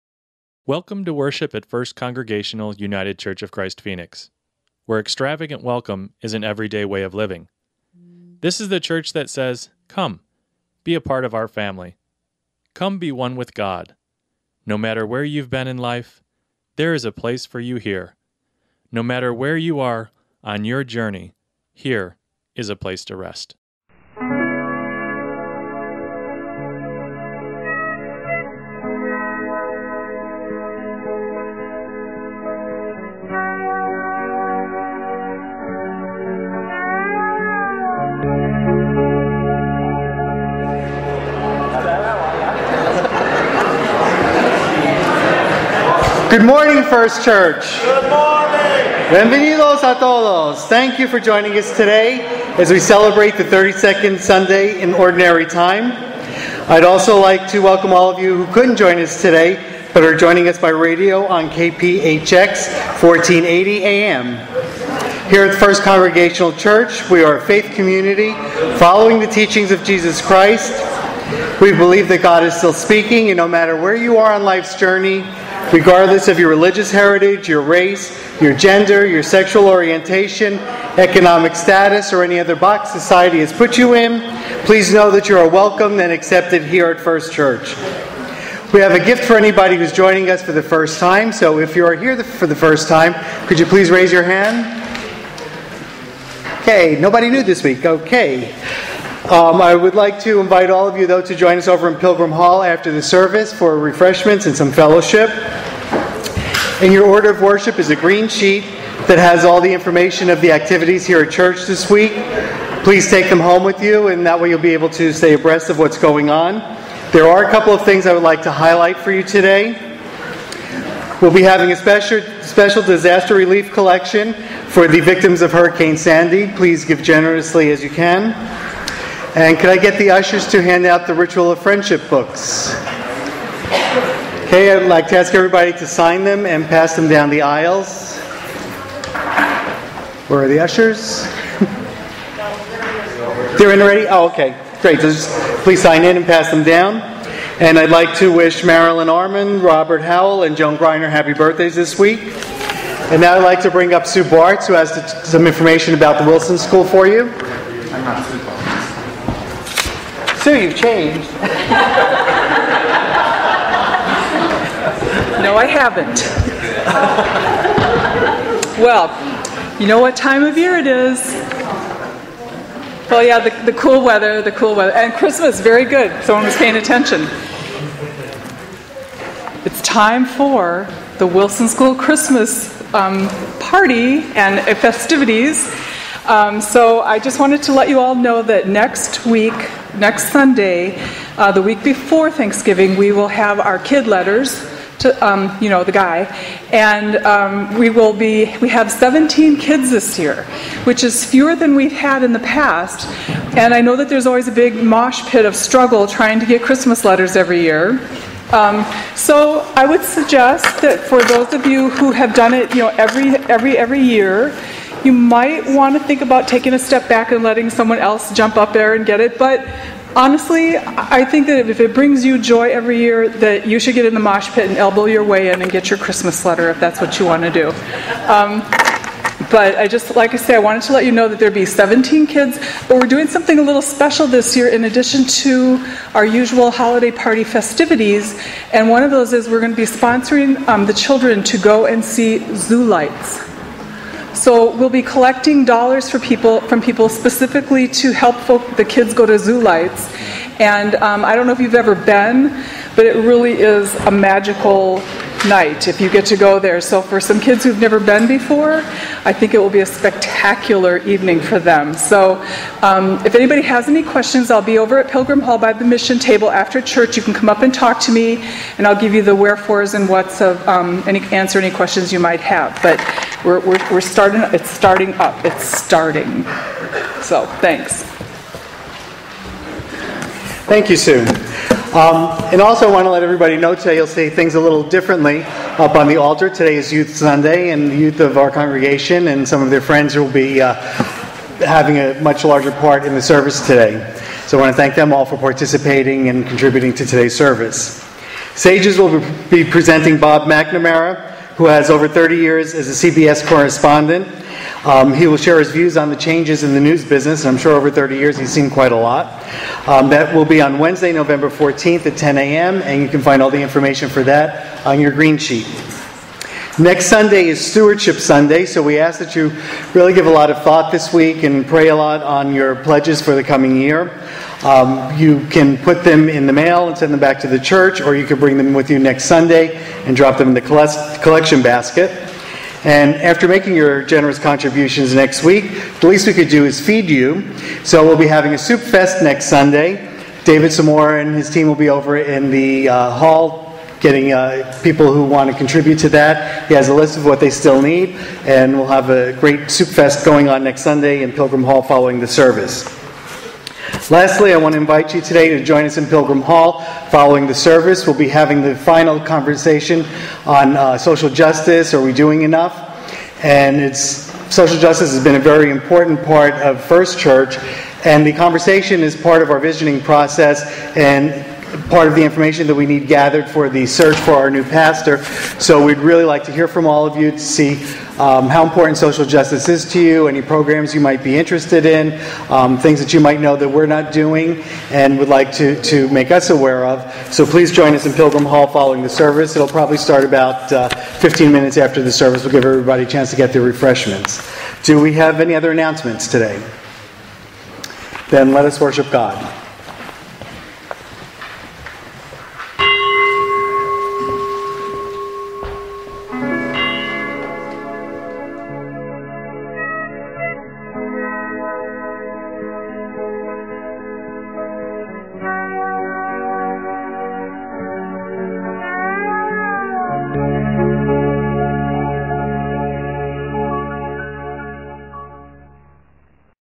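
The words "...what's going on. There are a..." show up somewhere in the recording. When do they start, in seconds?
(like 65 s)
115 s.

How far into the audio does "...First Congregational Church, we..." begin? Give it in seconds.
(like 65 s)
65 s.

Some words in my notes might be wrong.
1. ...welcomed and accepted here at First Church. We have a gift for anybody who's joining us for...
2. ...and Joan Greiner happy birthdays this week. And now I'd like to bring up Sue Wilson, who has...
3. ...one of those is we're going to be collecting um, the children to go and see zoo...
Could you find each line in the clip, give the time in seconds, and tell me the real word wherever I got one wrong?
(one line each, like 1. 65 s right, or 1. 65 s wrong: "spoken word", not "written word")
1. 85 s right
2. 150 s wrong: "Bartz", not "Wilson"
3. 238 s wrong: "sponsoring", not "collecting".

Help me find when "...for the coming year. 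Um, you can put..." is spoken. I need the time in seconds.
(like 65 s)
323 s.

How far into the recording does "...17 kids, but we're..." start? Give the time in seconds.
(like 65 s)
231 s.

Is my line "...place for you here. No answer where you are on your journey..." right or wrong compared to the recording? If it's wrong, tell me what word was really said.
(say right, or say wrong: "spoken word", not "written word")
wrong: "matter", not "answer".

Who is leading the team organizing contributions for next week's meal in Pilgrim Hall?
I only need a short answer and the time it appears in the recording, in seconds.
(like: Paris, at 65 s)
David Samora, at 340 s.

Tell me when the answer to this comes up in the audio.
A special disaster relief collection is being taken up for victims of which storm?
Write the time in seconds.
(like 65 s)
125 s.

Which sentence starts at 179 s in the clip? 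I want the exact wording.
It's time for the Wilson School Christmas um, party and festivities.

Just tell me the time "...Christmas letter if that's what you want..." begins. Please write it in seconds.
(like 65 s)
225 s.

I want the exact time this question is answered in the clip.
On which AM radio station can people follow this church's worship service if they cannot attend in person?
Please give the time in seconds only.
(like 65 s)
61 s.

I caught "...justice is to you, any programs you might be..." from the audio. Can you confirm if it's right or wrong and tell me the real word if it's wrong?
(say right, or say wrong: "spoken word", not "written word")
right.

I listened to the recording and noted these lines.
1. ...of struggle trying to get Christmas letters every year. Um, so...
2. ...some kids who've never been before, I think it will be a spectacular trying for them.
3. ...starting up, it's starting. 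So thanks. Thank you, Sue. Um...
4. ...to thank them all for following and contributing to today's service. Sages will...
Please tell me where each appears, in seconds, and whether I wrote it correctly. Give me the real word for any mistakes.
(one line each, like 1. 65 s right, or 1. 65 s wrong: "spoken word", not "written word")
1. 205 s right
2. 257 s wrong: "evening", not "trying"
3. 274 s right
4. 294 s wrong: "participating", not "following".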